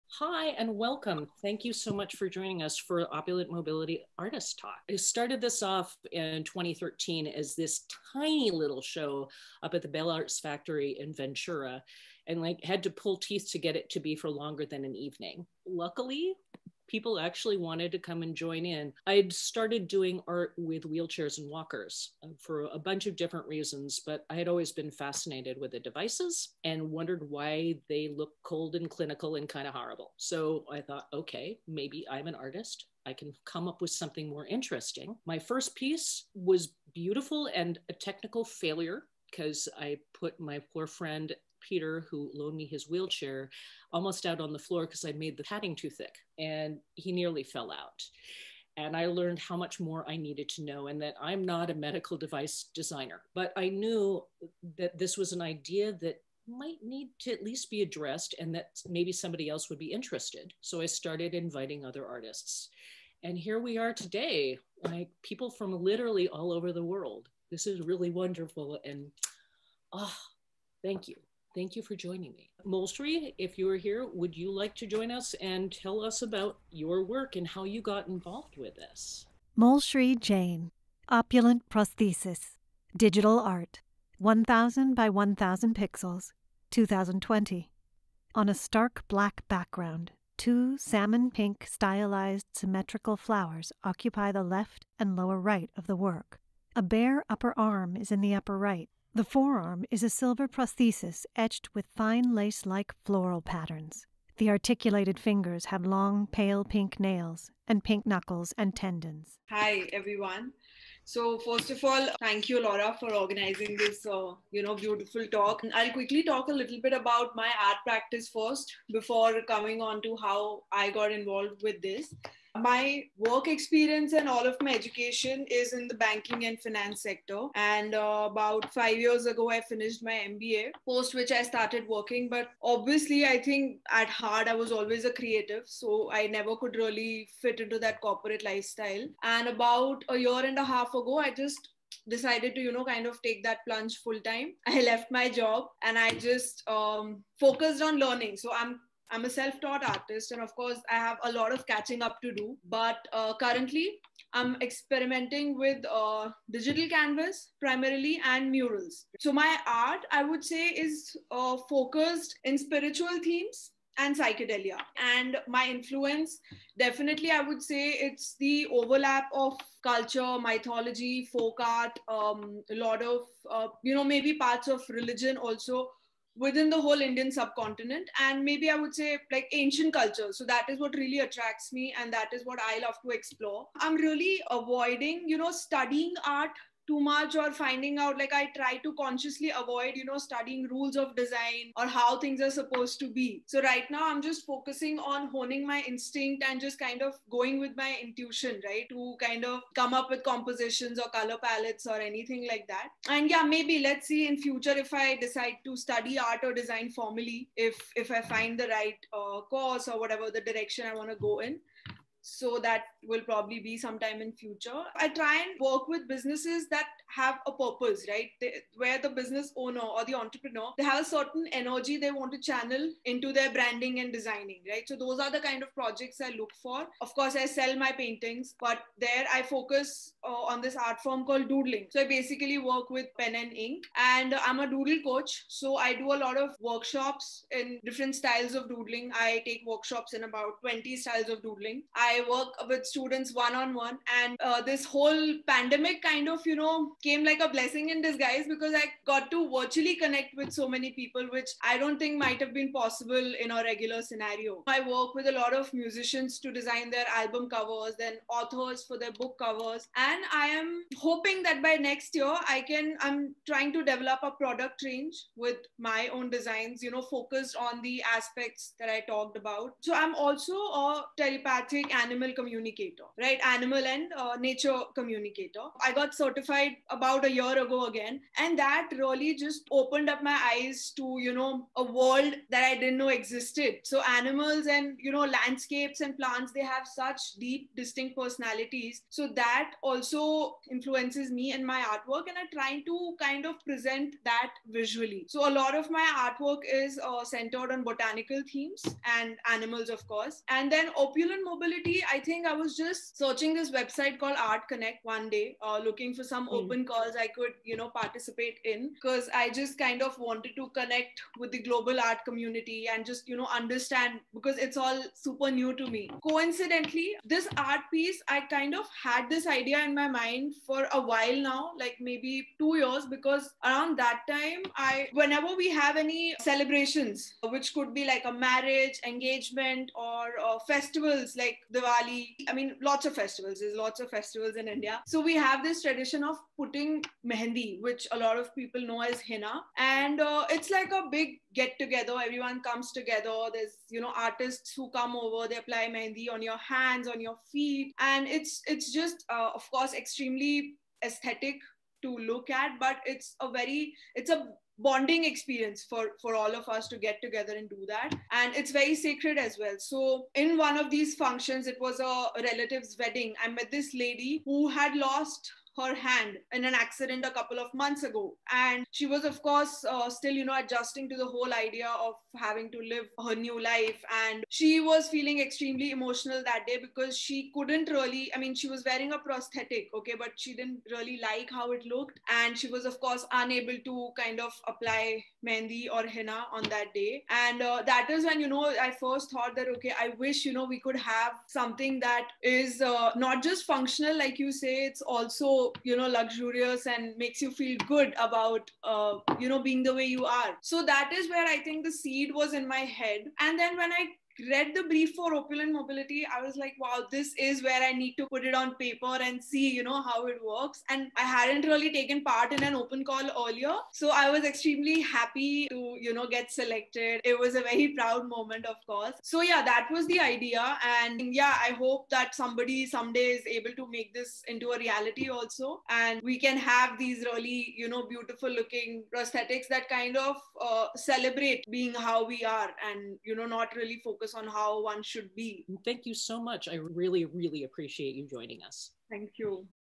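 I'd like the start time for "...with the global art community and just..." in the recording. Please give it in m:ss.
5:11.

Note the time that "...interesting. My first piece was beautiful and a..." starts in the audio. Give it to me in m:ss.
0:34.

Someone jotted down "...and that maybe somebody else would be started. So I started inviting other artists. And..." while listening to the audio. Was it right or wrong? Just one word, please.
wrong.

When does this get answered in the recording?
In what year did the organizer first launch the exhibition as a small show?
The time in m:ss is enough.
0:06.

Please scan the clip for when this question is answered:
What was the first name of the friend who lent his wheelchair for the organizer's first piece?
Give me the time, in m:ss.
0:41.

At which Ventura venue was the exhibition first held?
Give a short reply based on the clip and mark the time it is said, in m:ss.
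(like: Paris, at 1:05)
Bell Arts Factory, at 0:09.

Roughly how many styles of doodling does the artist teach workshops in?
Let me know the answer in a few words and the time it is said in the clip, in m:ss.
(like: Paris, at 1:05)
20, at 4:00.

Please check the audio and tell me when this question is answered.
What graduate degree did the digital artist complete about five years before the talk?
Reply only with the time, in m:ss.
2:10.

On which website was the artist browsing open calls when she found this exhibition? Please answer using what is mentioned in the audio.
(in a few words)
Art Connect.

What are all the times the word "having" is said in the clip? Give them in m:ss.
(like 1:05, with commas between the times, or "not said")
6:12.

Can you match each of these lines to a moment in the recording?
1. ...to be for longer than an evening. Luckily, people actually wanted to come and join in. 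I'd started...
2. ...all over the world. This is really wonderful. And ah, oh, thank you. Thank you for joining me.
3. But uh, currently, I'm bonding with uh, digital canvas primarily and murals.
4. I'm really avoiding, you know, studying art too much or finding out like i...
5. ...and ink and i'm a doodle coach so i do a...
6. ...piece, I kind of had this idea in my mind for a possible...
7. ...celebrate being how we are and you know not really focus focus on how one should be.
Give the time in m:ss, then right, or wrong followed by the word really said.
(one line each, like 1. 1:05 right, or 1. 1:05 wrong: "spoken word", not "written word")
1. 0:13 right
2. 1:06 right
3. 2:32 wrong: "experimenting", not "bonding"
4. 3:03 right
5. 3:53 right
6. 5:17 wrong: "while", not "possible"
7. 7:10 right.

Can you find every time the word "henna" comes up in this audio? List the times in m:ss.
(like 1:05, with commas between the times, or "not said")
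5:39, 6:26.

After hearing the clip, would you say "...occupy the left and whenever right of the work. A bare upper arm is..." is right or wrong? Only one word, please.
wrong.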